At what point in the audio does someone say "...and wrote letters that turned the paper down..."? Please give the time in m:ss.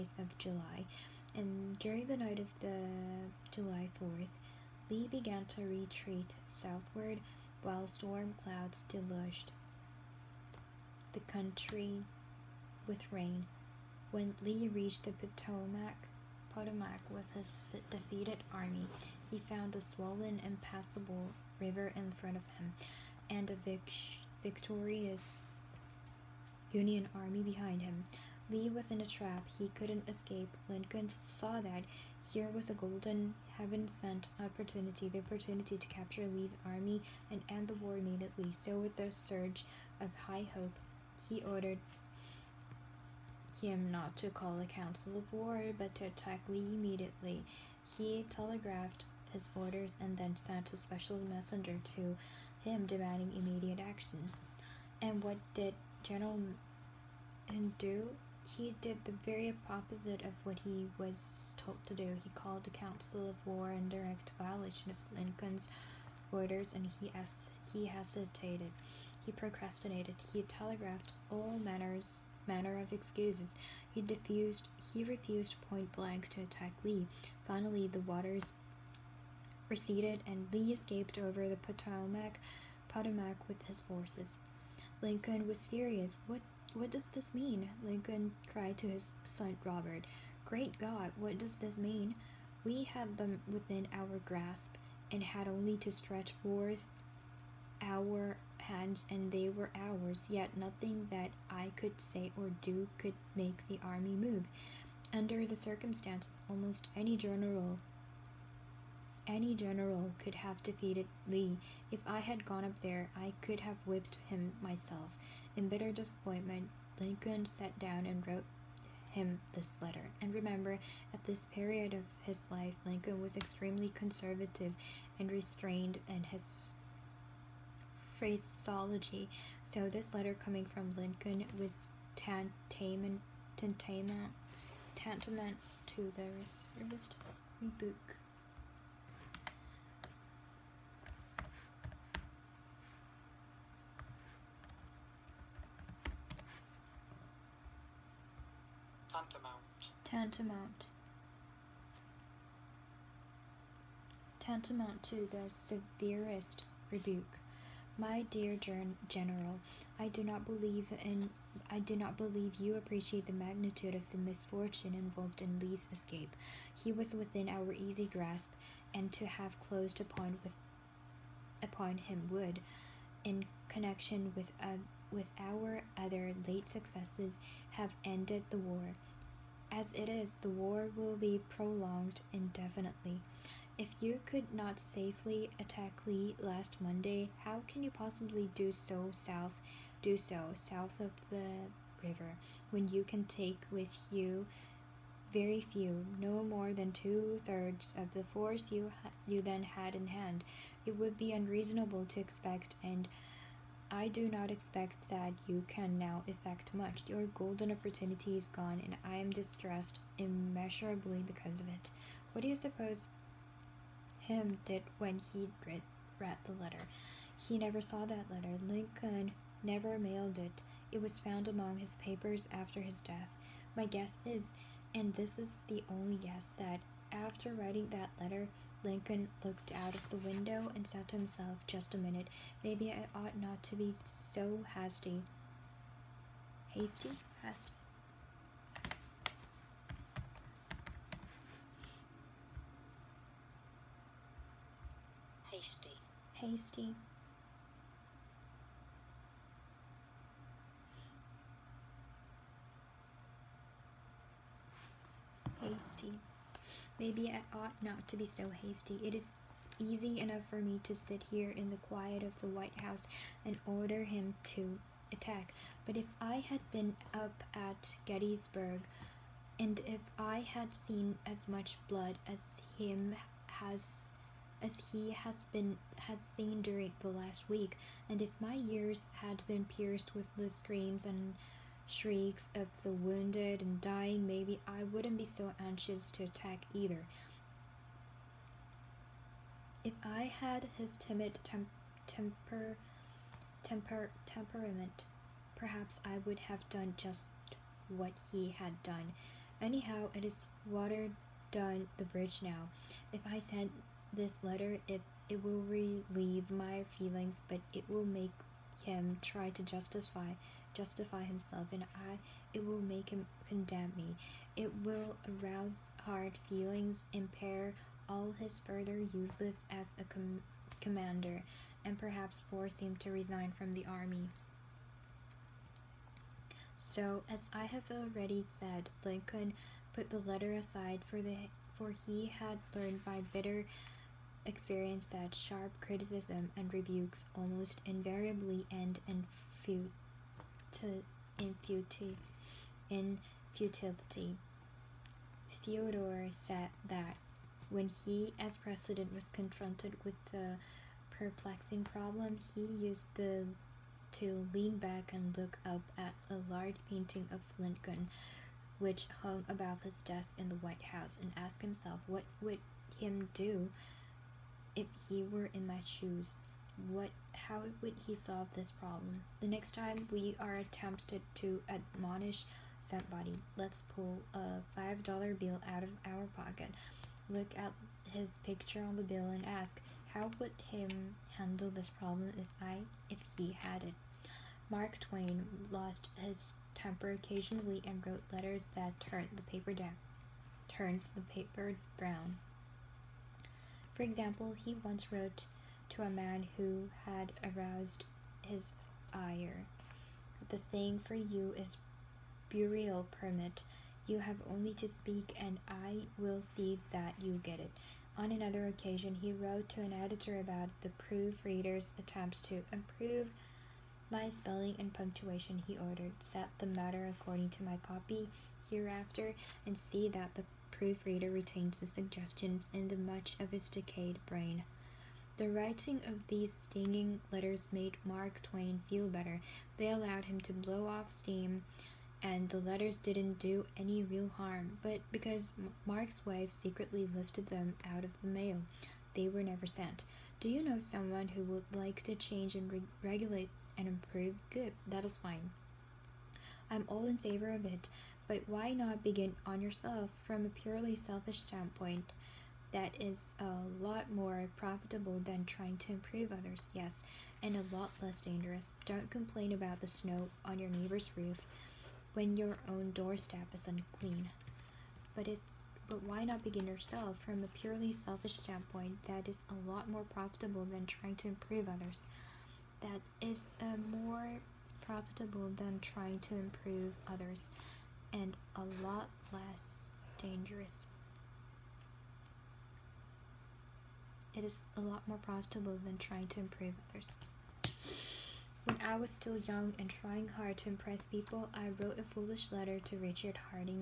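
6:27.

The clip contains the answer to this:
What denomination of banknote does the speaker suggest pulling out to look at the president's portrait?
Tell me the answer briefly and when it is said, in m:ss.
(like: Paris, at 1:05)
$5, at 6:14.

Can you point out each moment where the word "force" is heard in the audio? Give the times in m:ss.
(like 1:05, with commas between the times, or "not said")
1:23, 3:18, 5:22.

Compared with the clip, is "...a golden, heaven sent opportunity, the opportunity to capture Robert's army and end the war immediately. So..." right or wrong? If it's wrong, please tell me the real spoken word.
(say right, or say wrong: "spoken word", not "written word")
wrong: "Lee", not "Robert".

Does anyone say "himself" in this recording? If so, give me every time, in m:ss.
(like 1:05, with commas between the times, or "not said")
3:51, 5:11, 6:01.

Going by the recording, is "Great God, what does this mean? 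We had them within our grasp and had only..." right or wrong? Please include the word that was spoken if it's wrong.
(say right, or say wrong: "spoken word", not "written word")
right.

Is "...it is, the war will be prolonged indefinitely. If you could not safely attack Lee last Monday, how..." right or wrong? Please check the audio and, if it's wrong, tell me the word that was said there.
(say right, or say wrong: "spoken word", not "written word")
right.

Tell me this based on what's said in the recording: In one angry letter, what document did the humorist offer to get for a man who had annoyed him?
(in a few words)
burial permit.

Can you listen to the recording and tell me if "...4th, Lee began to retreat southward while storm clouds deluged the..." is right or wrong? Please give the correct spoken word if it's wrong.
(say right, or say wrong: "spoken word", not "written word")
right.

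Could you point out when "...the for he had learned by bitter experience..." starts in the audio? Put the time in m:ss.
5:31.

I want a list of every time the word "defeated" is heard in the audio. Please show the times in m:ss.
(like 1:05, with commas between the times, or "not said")
0:17, 1:50.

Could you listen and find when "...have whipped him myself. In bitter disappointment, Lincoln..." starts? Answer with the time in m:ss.
1:53.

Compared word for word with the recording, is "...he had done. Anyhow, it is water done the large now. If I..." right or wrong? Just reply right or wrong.
wrong.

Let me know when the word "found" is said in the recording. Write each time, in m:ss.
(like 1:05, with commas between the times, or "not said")
0:19, 3:41.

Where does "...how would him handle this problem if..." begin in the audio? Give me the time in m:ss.
6:20.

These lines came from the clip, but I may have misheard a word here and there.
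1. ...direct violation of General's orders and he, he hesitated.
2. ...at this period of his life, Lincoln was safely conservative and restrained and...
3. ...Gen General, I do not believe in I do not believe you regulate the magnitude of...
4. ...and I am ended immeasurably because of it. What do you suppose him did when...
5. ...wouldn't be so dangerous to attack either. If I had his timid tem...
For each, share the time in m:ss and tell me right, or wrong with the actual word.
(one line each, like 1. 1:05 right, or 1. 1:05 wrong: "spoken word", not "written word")
1. 1:03 wrong: "Lincoln", not "General"
2. 2:01 wrong: "extremely", not "safely"
3. 2:38 wrong: "appreciate", not "regulate"
4. 3:28 wrong: "distressed", not "ended"
5. 4:44 wrong: "anxious", not "dangerous".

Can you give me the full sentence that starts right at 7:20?
Do you know someone who would like to change and re regulate and improve?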